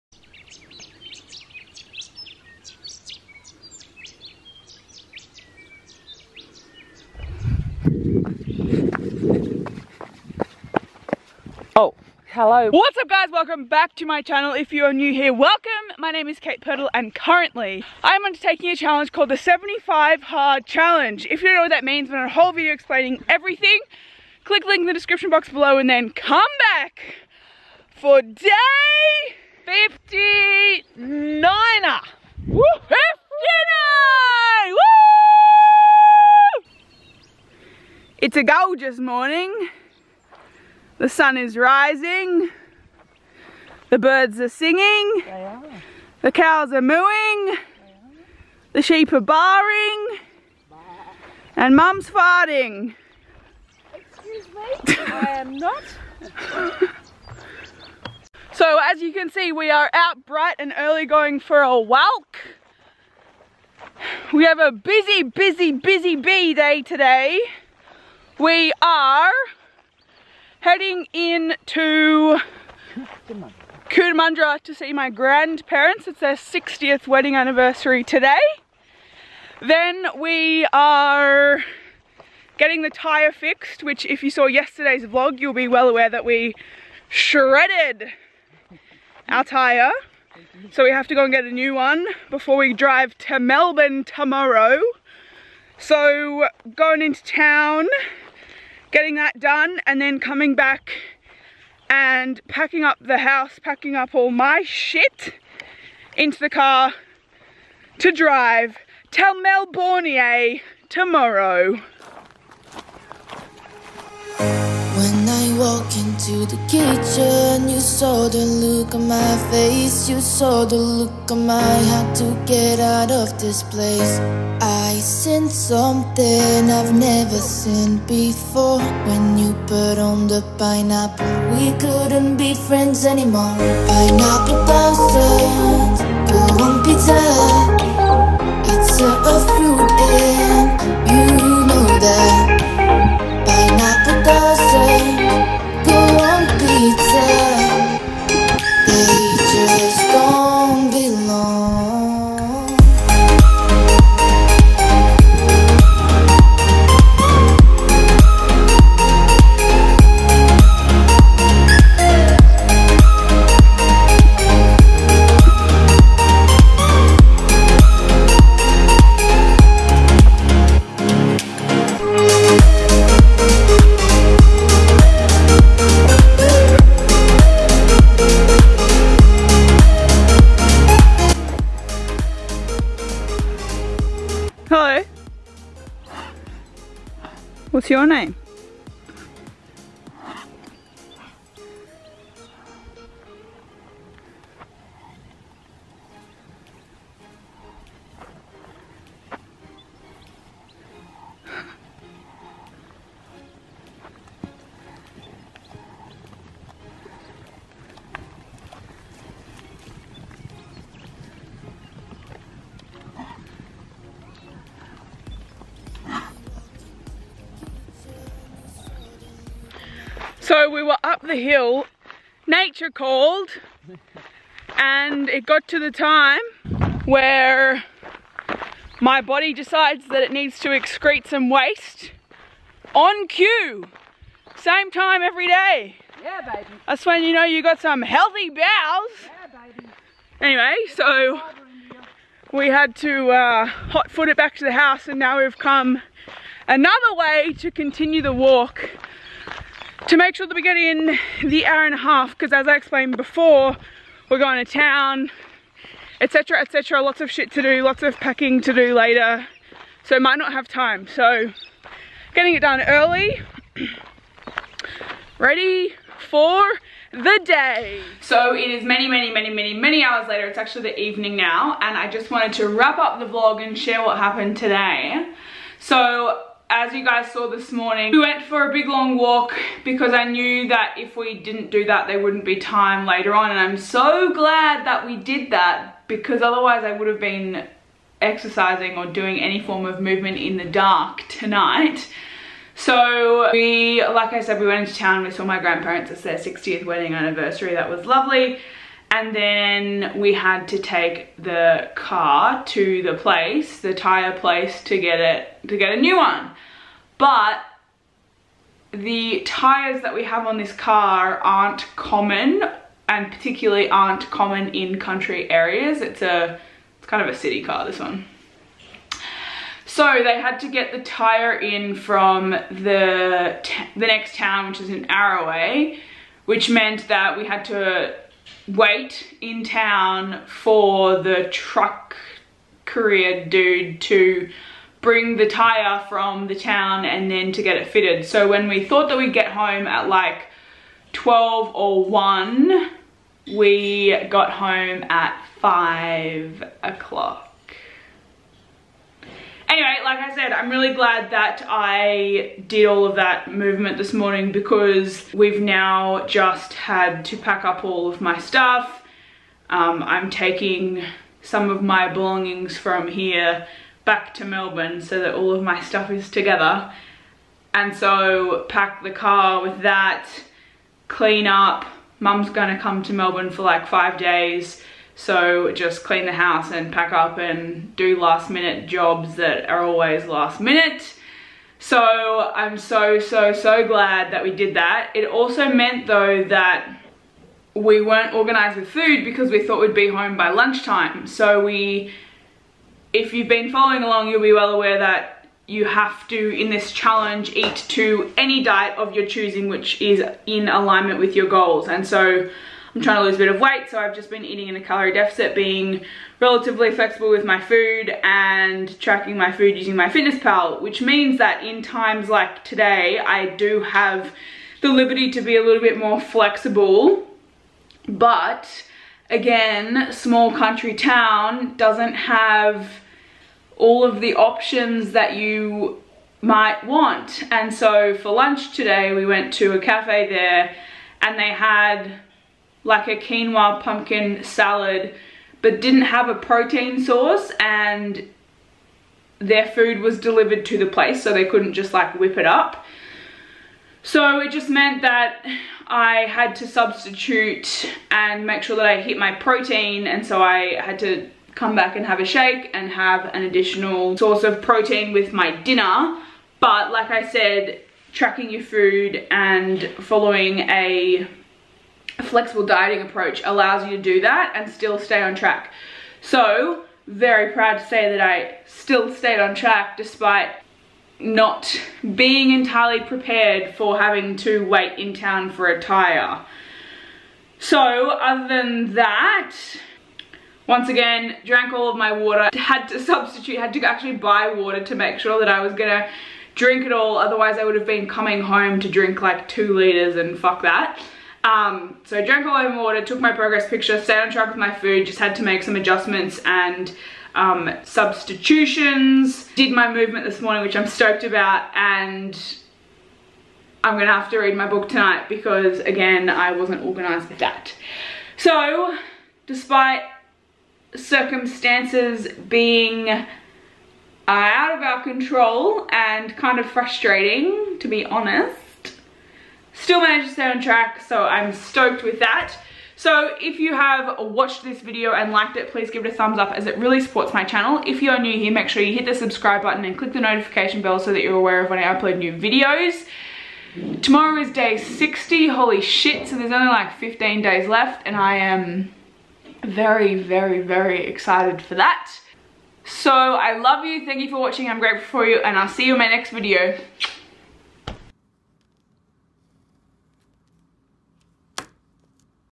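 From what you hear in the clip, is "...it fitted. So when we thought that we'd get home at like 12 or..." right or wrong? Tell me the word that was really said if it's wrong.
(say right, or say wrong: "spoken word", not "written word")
right.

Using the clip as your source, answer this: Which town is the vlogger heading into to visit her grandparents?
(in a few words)
Cootamundra.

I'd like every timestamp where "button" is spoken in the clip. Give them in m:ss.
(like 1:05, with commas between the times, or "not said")
8:49.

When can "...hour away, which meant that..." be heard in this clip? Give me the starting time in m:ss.
5:25.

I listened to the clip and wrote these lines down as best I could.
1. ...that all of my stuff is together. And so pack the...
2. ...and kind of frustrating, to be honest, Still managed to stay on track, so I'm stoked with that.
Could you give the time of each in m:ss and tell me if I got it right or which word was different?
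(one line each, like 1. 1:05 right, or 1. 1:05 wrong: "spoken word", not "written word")
1. 6:05 right
2. 8:35 right.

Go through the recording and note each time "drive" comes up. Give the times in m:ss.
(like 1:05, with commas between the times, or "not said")
1:32, 1:48.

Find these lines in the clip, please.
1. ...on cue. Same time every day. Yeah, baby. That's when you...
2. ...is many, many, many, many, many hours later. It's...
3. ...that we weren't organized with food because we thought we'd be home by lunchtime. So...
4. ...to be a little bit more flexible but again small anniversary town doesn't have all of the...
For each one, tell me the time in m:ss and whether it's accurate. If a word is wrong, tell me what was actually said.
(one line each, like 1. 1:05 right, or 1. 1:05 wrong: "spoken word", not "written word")
1. 3:52 right
2. 4:28 right
3. 6:26 right
4. 6:55 wrong: "country", not "anniversary".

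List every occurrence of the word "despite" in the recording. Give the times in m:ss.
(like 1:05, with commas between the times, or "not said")
7:49, 8:29.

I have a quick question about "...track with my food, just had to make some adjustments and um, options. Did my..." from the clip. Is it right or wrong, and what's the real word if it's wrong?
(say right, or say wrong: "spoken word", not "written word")
wrong: "substitutions", not "options".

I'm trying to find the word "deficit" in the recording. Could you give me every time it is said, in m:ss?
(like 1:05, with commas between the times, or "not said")
6:45.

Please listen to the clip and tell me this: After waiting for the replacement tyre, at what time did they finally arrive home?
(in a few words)
5 o'clock.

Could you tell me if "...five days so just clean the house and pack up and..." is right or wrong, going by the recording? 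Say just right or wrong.
right.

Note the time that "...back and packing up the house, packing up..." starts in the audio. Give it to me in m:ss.
1:40.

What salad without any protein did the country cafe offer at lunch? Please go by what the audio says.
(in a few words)
quinoa pumpkin salad.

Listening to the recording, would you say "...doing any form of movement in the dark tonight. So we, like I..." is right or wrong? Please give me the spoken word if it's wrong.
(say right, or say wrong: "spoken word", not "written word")
right.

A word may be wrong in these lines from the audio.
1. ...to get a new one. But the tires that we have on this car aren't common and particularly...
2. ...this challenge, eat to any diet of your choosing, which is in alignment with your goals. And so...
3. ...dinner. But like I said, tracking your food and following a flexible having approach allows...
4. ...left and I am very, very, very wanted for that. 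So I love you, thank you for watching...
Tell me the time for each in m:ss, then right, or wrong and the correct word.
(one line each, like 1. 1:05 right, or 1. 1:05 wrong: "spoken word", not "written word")
1. 5:05 right
2. 6:36 right
3. 7:35 wrong: "dieting", not "having"
4. 8:57 wrong: "excited", not "wanted".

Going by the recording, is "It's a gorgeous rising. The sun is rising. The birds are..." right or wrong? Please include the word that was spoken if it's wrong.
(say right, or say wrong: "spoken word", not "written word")
wrong: "morning", not "rising".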